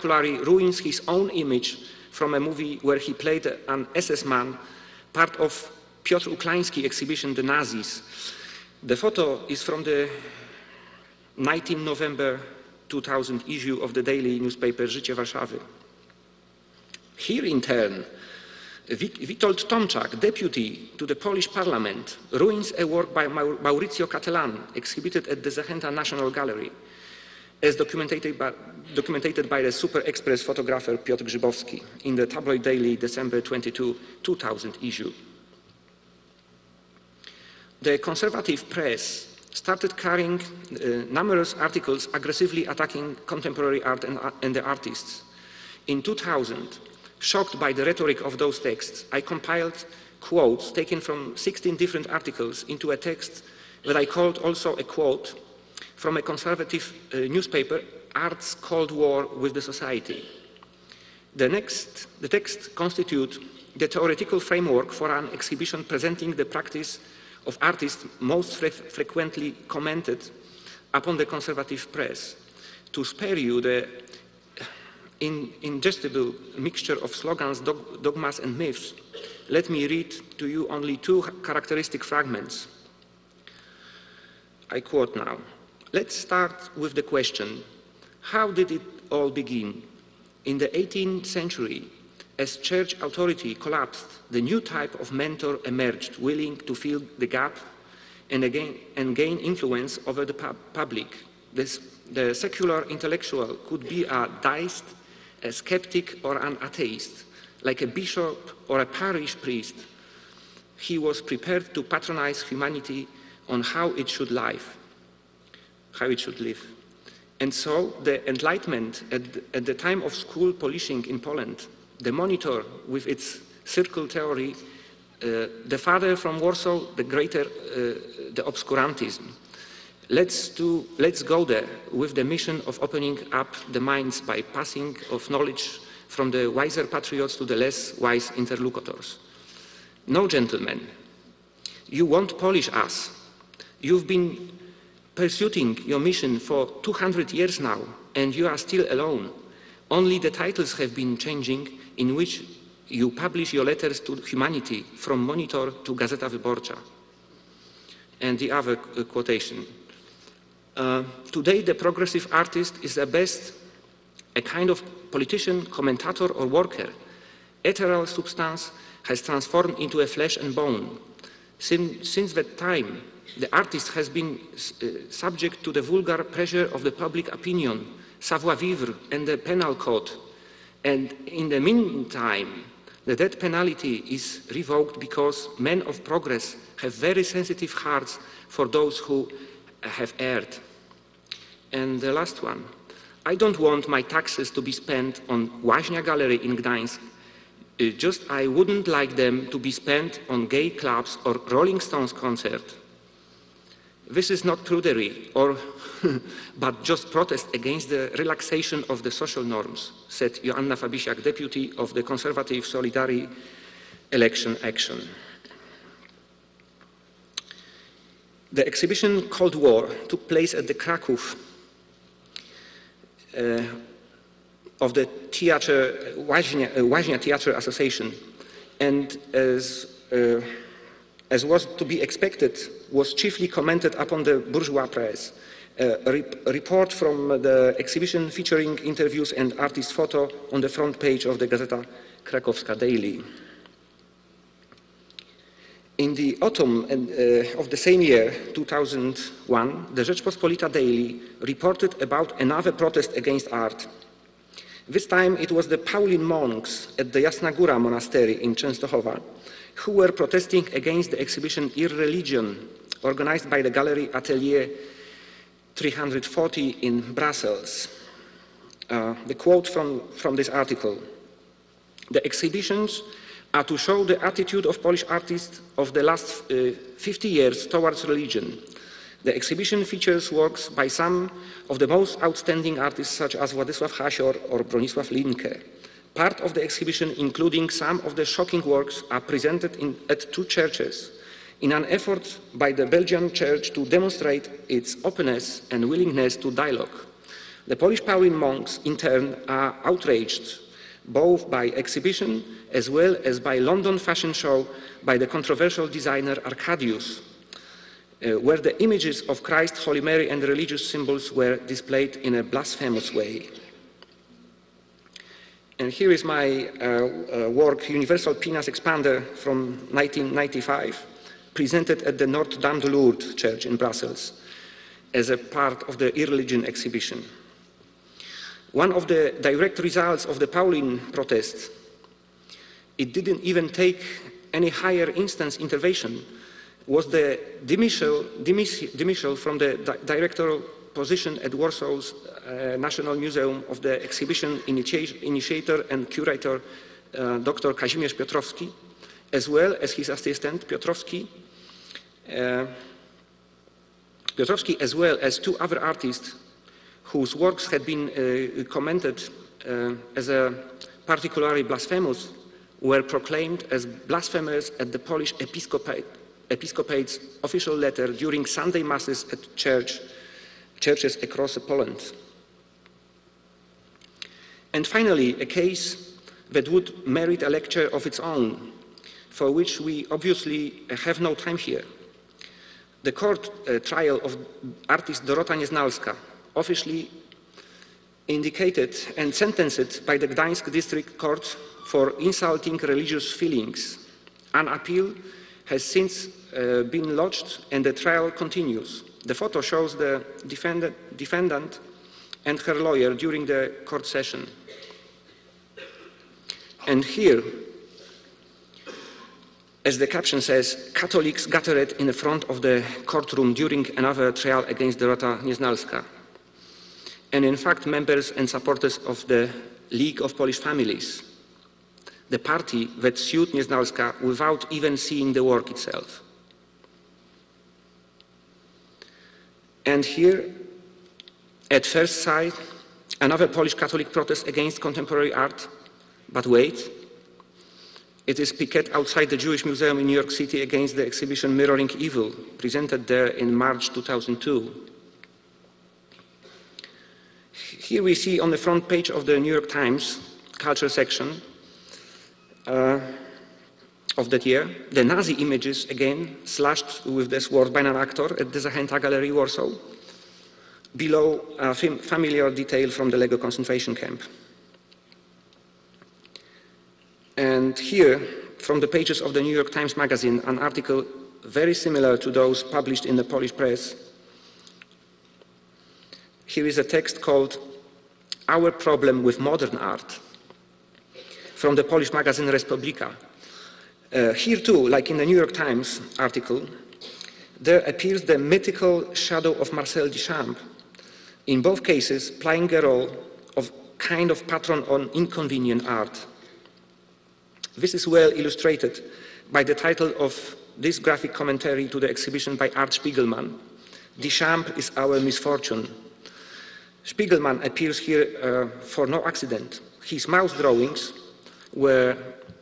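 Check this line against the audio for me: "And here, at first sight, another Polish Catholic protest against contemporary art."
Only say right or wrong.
right.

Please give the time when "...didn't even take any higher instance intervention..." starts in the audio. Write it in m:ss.
5:33.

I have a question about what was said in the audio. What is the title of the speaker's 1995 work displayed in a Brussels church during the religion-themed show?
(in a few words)
Universal Penis Expander.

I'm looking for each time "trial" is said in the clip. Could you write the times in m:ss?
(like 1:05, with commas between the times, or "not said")
6:23, 6:37, 6:54.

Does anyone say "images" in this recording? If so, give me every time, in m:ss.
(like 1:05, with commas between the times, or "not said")
0:01, 5:08, 7:35.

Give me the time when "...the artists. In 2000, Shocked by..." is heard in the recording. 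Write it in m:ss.
0:44.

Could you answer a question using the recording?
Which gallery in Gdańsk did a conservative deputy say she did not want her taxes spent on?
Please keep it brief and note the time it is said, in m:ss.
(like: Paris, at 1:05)
Łaźnia Gallery, at 3:15.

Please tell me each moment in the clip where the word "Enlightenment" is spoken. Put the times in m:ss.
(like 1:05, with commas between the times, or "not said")
1:58.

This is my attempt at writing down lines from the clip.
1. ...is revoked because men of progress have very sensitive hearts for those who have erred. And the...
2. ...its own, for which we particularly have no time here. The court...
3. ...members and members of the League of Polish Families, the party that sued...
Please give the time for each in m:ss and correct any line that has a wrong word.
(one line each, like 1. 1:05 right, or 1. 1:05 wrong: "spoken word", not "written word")
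1. 3:04 right
2. 6:18 wrong: "obviously", not "particularly"
3. 6:57 wrong: "supporters", not "members".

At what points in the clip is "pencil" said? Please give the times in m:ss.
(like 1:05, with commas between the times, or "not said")
not said.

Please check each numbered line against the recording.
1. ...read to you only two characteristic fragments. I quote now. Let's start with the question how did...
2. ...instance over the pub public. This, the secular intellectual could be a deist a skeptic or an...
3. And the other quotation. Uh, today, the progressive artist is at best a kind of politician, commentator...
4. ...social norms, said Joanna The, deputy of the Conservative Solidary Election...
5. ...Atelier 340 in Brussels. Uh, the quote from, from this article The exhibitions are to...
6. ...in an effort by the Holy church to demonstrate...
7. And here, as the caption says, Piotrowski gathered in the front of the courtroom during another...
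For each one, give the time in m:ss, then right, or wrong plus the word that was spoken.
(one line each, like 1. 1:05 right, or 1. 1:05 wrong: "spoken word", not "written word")
1. 1:19 right
2. 1:39 wrong: "influence", not "instance"
3. 2:38 right
4. 3:29 wrong: "Fabisiak", not "The"
5. 4:24 right
6. 4:51 wrong: "Belgian", not "Holy"
7. 6:46 wrong: "Catholics", not "Piotrowski".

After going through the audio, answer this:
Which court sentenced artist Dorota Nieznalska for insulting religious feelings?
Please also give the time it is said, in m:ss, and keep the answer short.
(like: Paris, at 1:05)
Gdańsk District Court, at 6:30.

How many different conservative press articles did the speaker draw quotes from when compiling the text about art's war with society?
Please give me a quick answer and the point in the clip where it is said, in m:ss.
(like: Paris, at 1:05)
16, at 0:51.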